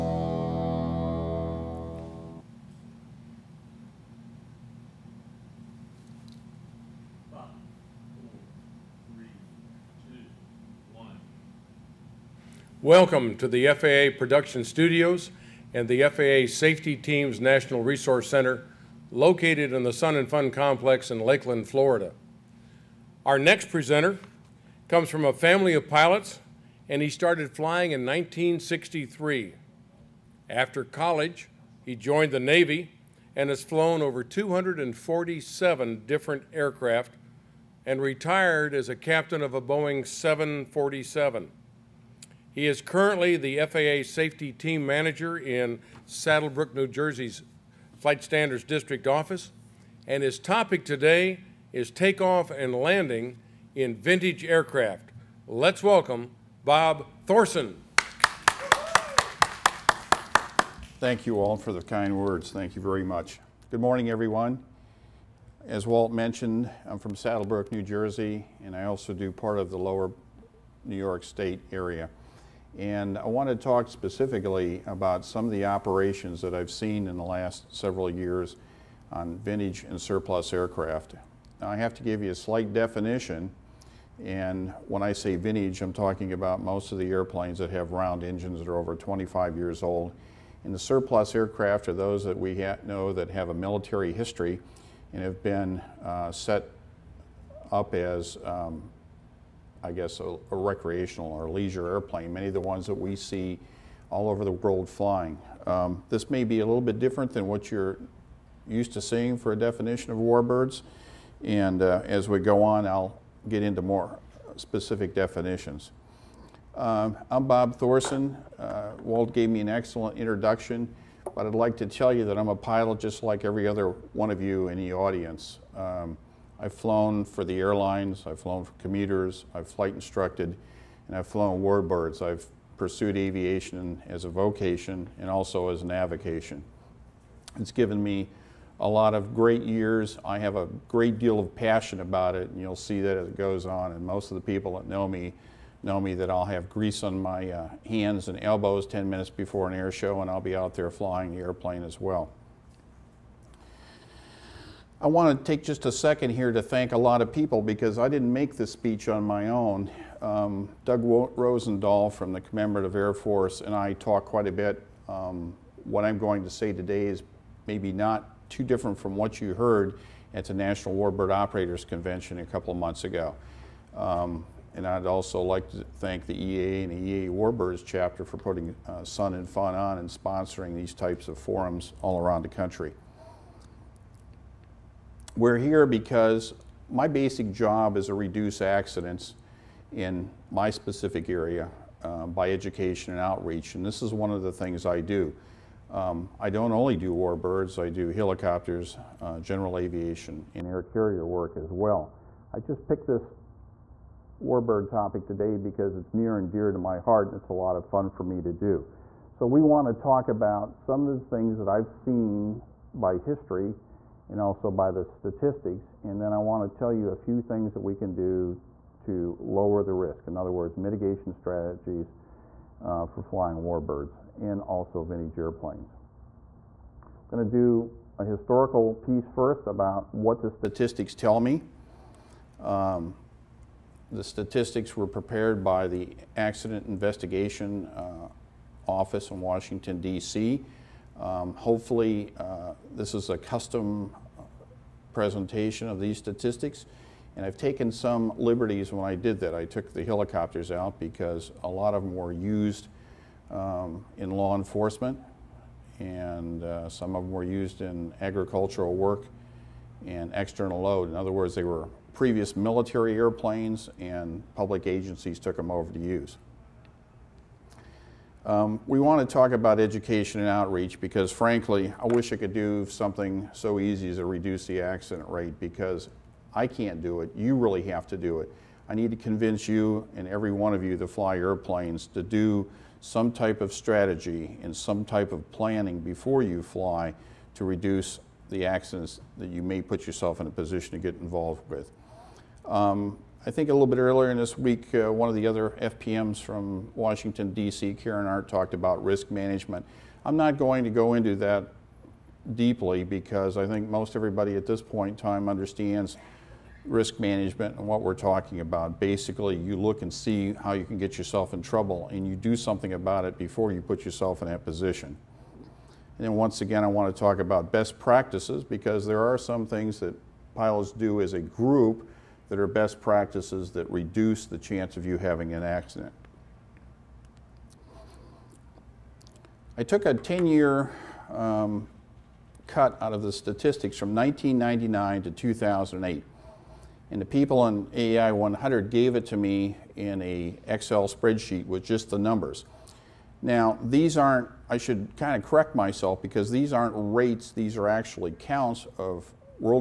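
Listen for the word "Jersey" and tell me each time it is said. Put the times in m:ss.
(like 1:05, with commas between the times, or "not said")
0:46, 1:07.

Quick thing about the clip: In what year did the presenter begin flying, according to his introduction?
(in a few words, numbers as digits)
1963.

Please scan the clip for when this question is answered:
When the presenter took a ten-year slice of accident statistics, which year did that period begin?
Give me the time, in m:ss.
5:34.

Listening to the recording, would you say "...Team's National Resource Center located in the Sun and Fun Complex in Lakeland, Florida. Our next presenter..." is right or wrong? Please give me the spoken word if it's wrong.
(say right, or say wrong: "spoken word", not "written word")
right.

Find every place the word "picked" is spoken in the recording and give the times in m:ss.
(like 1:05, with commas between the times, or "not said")
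3:22.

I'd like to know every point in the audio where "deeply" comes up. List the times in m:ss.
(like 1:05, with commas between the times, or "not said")
5:02.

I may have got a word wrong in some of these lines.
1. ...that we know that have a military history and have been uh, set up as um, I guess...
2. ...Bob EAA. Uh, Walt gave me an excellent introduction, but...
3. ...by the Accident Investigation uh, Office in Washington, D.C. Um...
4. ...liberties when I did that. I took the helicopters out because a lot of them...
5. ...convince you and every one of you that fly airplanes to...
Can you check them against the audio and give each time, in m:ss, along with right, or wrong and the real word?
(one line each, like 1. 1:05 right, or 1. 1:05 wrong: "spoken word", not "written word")
1. 1:32 right
2. 1:57 wrong: "Thorson", not "EAA"
3. 3:55 right
4. 4:08 right
5. 4:39 right.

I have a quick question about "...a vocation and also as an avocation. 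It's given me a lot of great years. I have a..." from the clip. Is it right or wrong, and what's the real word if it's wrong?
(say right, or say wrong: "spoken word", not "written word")
right.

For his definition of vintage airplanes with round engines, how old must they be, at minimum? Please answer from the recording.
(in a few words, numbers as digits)
25 years.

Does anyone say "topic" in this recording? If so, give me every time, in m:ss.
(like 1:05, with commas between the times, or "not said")
0:50, 3:24.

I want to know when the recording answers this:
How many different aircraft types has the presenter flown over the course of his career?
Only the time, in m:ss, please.
0:34.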